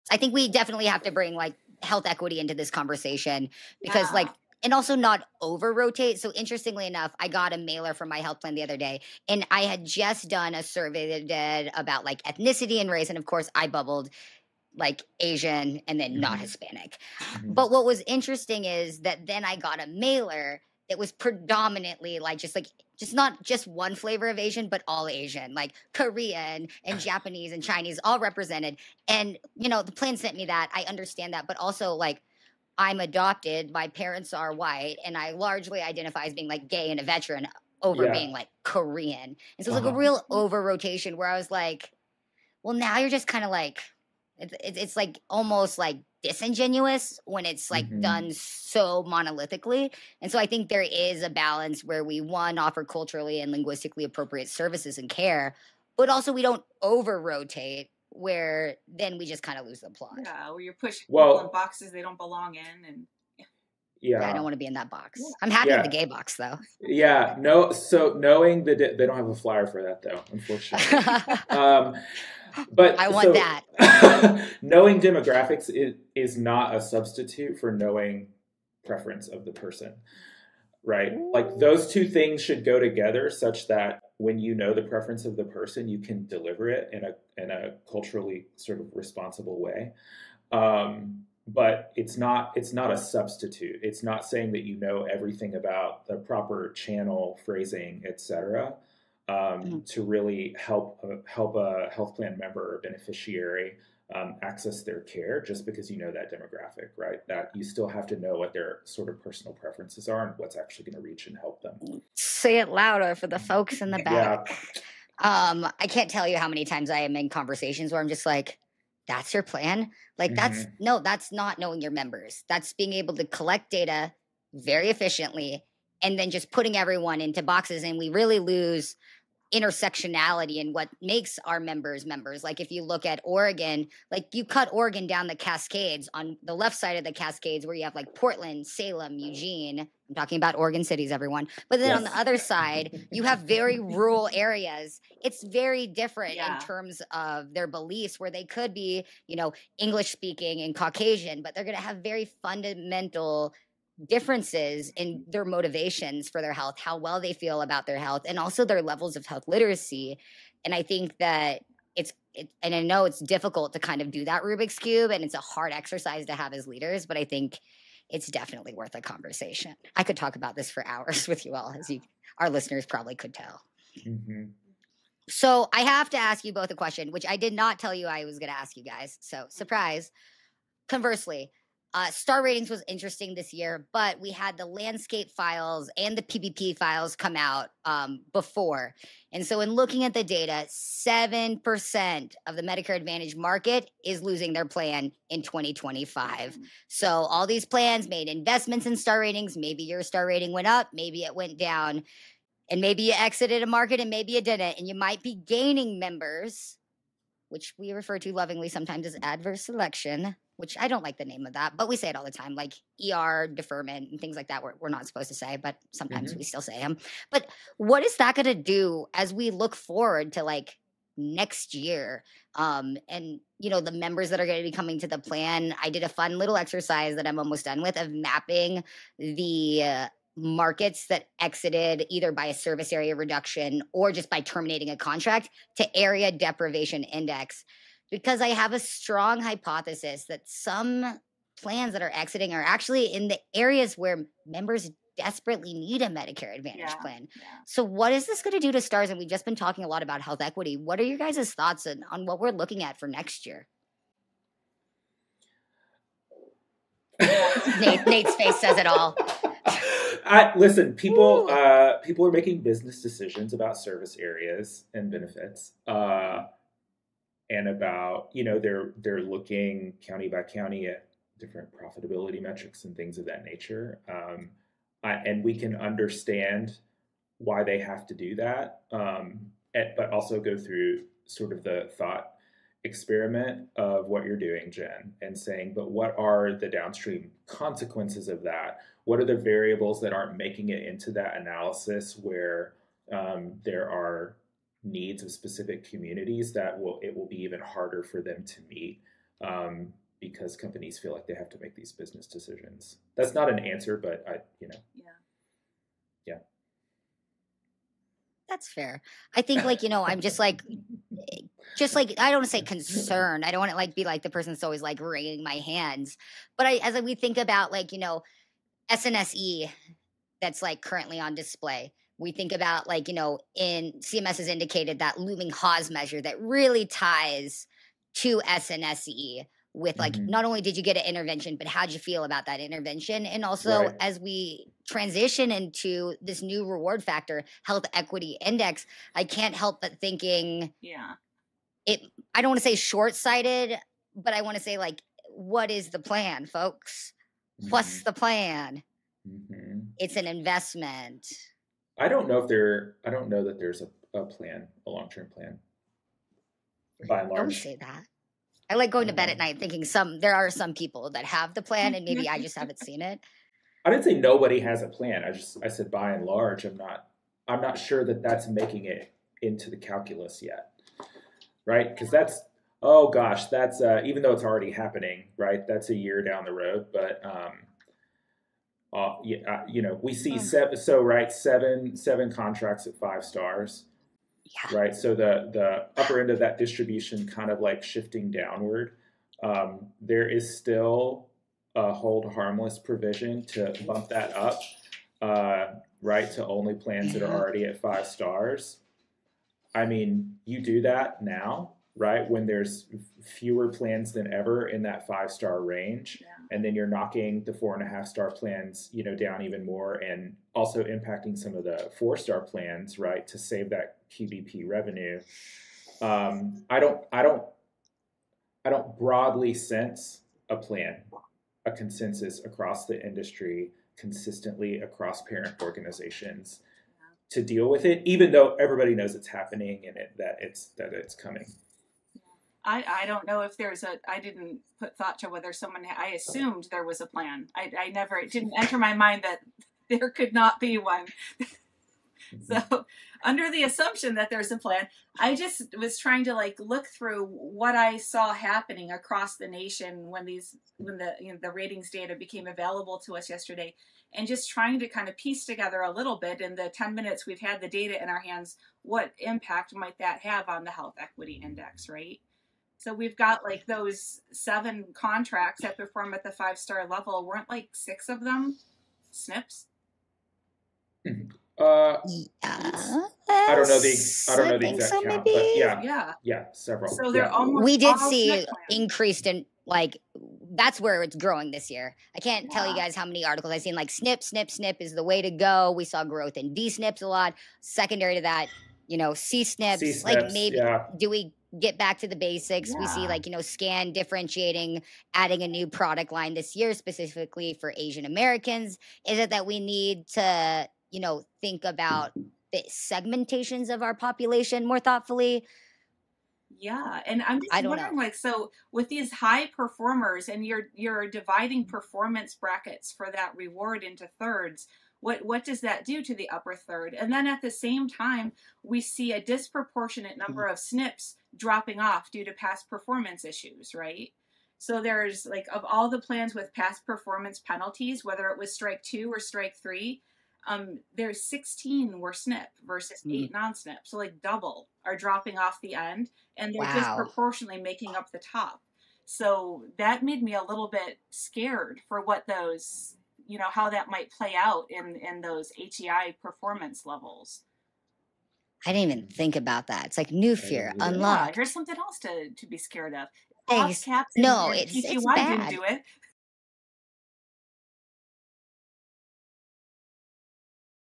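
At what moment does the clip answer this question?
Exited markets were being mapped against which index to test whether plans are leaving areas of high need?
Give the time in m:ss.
3:55.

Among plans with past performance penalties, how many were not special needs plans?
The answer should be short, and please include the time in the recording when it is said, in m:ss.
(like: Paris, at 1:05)
8, at 8:53.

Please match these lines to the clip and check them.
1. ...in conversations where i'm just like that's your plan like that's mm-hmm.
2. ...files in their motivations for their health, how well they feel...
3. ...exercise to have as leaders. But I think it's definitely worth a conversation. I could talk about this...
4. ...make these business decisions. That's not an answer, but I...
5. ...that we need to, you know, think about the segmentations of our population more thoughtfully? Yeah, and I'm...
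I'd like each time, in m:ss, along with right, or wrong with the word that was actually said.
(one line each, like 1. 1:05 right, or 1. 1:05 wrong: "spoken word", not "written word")
1. 1:57 right
2. 2:34 wrong: "differences", not "files"
3. 2:45 right
4. 5:01 right
5. 8:19 right.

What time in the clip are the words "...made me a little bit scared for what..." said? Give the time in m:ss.
9:00.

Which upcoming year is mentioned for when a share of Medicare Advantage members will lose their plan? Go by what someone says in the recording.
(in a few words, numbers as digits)
2025.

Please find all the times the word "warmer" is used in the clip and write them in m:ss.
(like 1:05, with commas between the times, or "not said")
not said.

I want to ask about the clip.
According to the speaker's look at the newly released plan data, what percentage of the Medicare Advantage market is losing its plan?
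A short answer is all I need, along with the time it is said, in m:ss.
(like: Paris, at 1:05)
7%, at 3:10.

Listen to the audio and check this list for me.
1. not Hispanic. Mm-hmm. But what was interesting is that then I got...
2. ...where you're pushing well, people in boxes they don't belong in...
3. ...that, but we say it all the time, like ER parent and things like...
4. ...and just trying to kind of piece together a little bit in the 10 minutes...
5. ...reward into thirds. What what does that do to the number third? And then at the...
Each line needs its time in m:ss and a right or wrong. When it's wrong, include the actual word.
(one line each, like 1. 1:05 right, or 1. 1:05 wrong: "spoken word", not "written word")
1. 0:16 right
2. 1:00 right
3. 3:31 wrong: "deferment", not "parent"
4. 7:34 right
5. 8:33 wrong: "upper", not "number".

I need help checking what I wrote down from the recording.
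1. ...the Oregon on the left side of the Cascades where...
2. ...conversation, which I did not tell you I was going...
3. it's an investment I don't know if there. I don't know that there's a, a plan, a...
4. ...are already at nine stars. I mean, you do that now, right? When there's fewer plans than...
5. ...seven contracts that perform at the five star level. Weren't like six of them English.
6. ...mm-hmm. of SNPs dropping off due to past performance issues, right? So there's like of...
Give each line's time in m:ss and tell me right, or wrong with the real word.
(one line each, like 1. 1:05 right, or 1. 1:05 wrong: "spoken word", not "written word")
1. 2:15 wrong: "Cascades", not "Oregon"
2. 2:56 wrong: "question", not "conversation"
3. 5:49 right
4. 6:37 wrong: "five", not "nine"
5. 7:44 wrong: "SNPs", not "English"
6. 8:40 right.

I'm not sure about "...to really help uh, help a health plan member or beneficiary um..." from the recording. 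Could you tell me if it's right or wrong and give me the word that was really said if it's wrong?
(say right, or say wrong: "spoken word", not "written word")
right.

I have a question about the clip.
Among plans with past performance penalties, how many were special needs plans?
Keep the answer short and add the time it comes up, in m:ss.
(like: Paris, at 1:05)
16, at 8:51.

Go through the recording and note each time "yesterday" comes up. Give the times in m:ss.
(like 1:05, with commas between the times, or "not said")
7:33.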